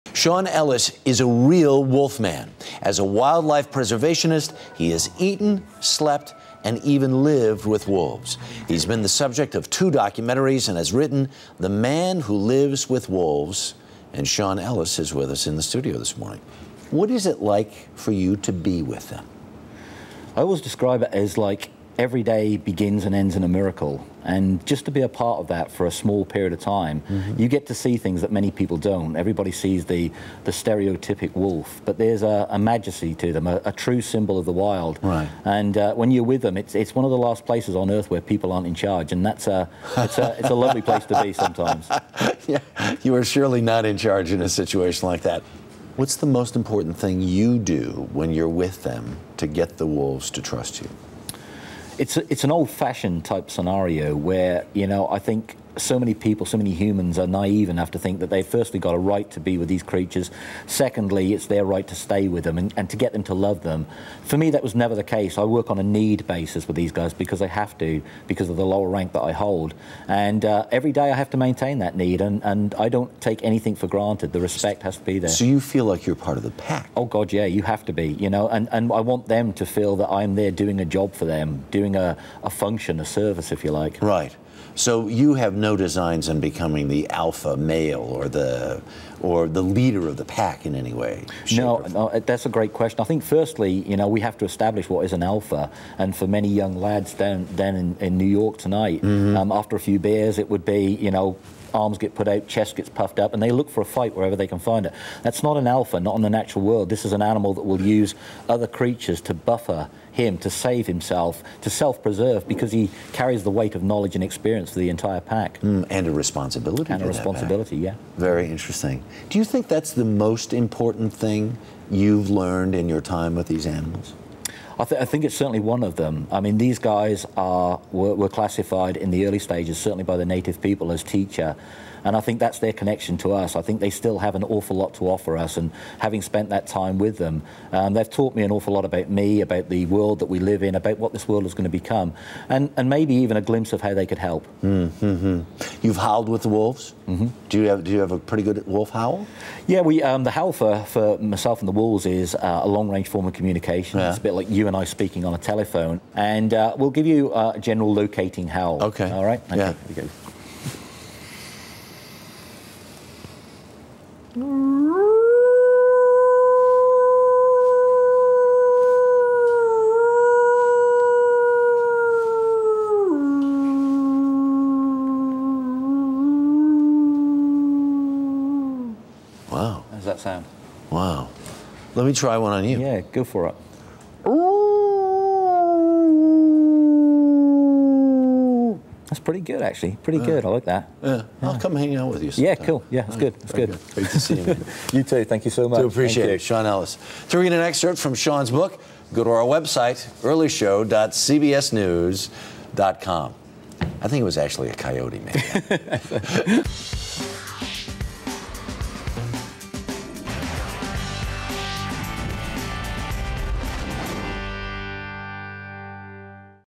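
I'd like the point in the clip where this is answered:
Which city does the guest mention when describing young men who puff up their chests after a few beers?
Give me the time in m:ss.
1:38.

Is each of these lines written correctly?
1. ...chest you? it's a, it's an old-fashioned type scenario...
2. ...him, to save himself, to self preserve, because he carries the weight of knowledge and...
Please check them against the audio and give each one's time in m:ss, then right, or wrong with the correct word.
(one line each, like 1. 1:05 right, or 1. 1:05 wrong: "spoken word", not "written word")
1. 0:50 wrong: "trust", not "chest"
2. 1:50 right.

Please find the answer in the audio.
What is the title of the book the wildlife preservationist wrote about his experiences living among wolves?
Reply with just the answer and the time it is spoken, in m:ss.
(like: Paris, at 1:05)
The Man Who Lives with Wolves, at 0:11.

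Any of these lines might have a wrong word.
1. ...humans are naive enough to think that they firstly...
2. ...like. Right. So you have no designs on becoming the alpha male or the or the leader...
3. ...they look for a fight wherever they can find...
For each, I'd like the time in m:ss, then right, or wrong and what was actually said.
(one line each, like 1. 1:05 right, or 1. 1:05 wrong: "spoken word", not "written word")
1. 0:56 right
2. 1:23 right
3. 1:43 right.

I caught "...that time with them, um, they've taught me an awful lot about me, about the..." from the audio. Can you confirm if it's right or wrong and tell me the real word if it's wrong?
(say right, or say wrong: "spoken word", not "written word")
right.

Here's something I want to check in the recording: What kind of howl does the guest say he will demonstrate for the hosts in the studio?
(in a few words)
a general locating howl.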